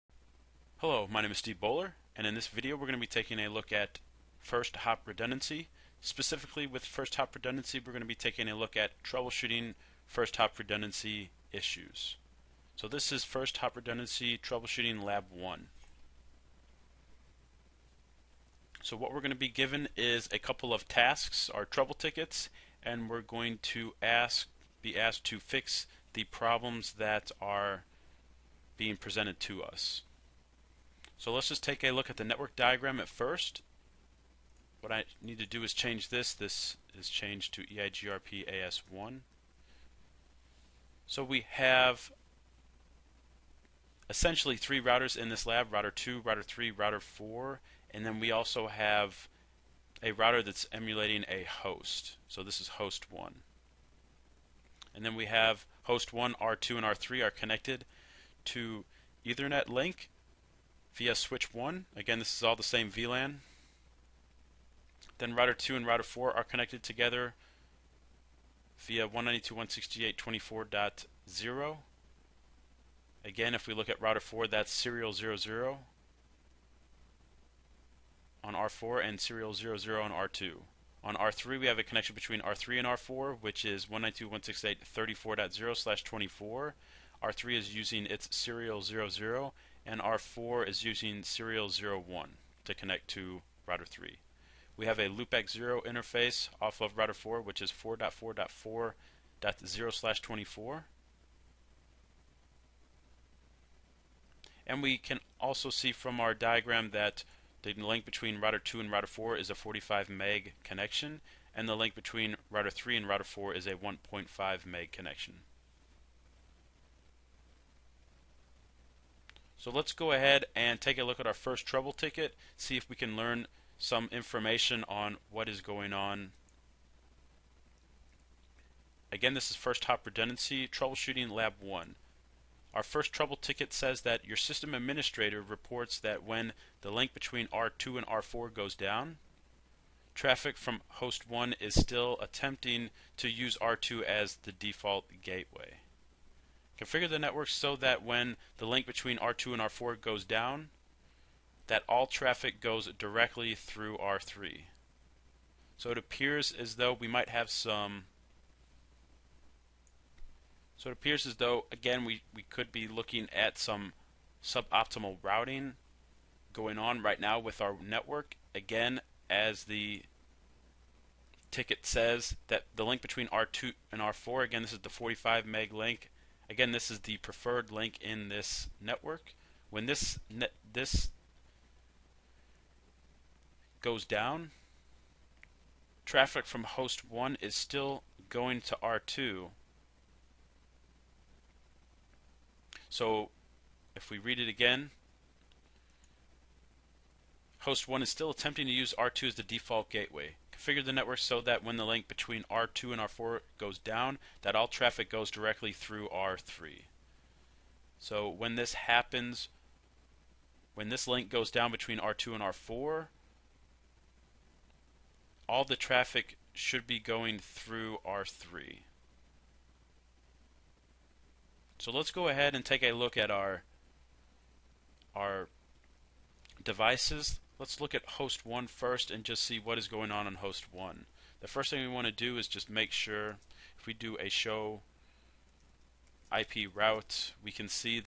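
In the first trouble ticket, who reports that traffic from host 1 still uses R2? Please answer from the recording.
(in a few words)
system administrator.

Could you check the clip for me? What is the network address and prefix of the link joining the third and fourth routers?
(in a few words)
192.168.34.0/24.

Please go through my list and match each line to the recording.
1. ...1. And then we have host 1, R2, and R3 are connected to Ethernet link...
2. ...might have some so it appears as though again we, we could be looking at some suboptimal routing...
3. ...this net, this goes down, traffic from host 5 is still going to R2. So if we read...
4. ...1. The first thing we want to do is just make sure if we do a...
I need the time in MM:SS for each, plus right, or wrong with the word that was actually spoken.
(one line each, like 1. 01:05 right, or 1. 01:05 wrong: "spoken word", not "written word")
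1. 00:53 right
2. 02:37 right
3. 02:59 wrong: "1", not "5"
4. 03:50 right.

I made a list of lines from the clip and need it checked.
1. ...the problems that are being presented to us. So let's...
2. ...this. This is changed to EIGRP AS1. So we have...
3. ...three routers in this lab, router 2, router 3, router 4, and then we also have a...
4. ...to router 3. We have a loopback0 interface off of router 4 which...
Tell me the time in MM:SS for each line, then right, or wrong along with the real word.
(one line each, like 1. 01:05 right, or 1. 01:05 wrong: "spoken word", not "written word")
1. 00:26 right
2. 00:36 right
3. 00:44 right
4. 01:33 right.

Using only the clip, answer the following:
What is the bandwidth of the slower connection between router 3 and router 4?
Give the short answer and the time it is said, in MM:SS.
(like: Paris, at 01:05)
1.5 meg, at 01:53.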